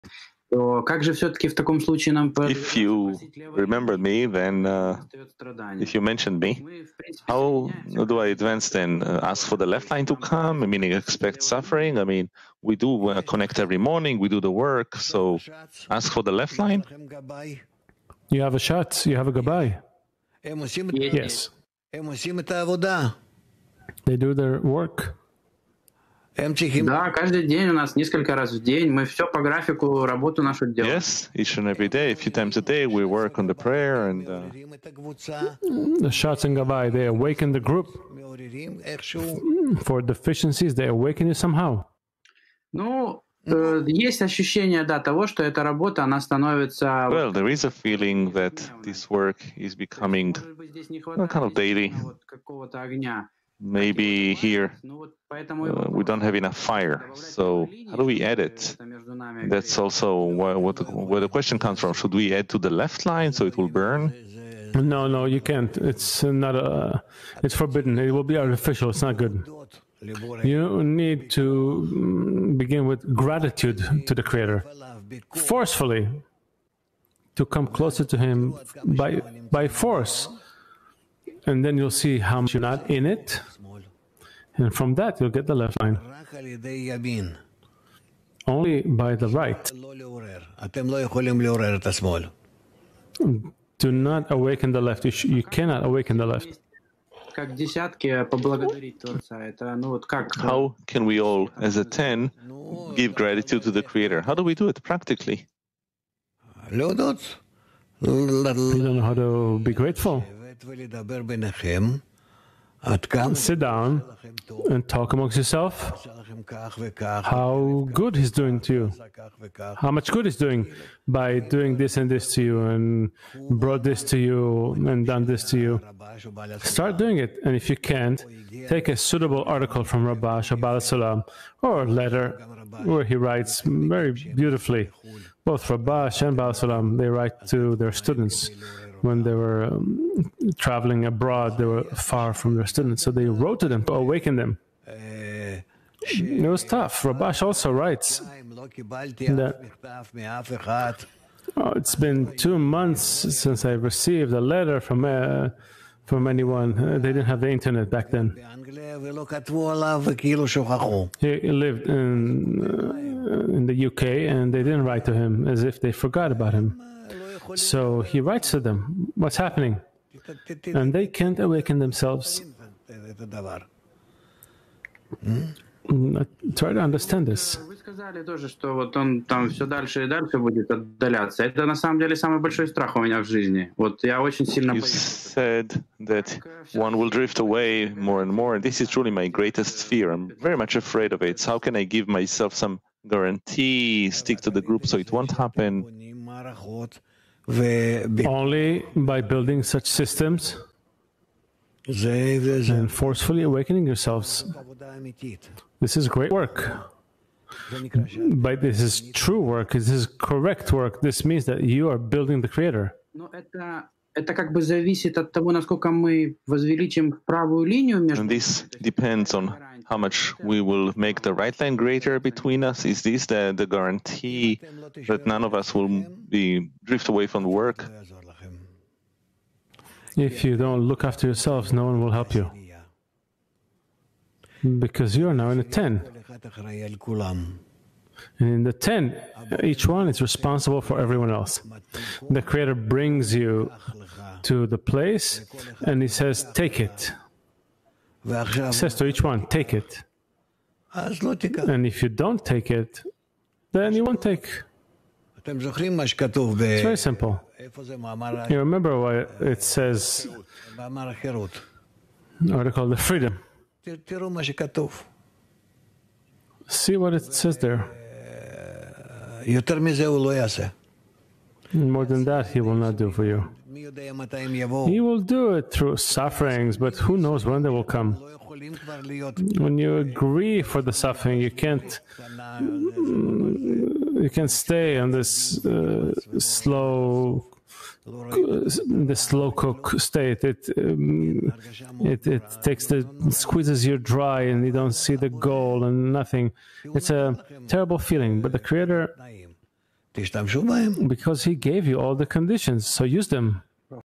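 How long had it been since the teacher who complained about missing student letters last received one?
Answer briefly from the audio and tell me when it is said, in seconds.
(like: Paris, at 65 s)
2 months, at 152 s.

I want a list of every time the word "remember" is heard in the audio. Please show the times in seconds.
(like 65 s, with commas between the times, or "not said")
3 s, 258 s.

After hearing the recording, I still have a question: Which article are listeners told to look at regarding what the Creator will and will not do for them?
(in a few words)
The Freedom.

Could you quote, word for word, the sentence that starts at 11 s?
I mean, we do uh, connect every morning, we do the work, so ask for the left line.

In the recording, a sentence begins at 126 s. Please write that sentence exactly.
Start doing it, and if you can't, take a suitable article from Rabash Shabbat Salam or letter where he writes very beautifully.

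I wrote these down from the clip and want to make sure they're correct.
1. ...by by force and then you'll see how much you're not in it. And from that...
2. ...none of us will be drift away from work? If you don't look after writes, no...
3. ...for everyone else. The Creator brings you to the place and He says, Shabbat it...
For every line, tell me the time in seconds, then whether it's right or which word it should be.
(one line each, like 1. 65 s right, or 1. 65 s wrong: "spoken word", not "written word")
1. 78 s right
2. 225 s wrong: "yourselves", not "writes"
3. 240 s wrong: "Take", not "Shabbat".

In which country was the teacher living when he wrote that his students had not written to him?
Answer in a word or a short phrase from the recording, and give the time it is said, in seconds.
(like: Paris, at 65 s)
UK, at 163 s.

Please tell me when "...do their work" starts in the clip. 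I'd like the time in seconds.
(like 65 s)
24 s.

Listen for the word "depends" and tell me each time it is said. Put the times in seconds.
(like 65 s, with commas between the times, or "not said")
218 s.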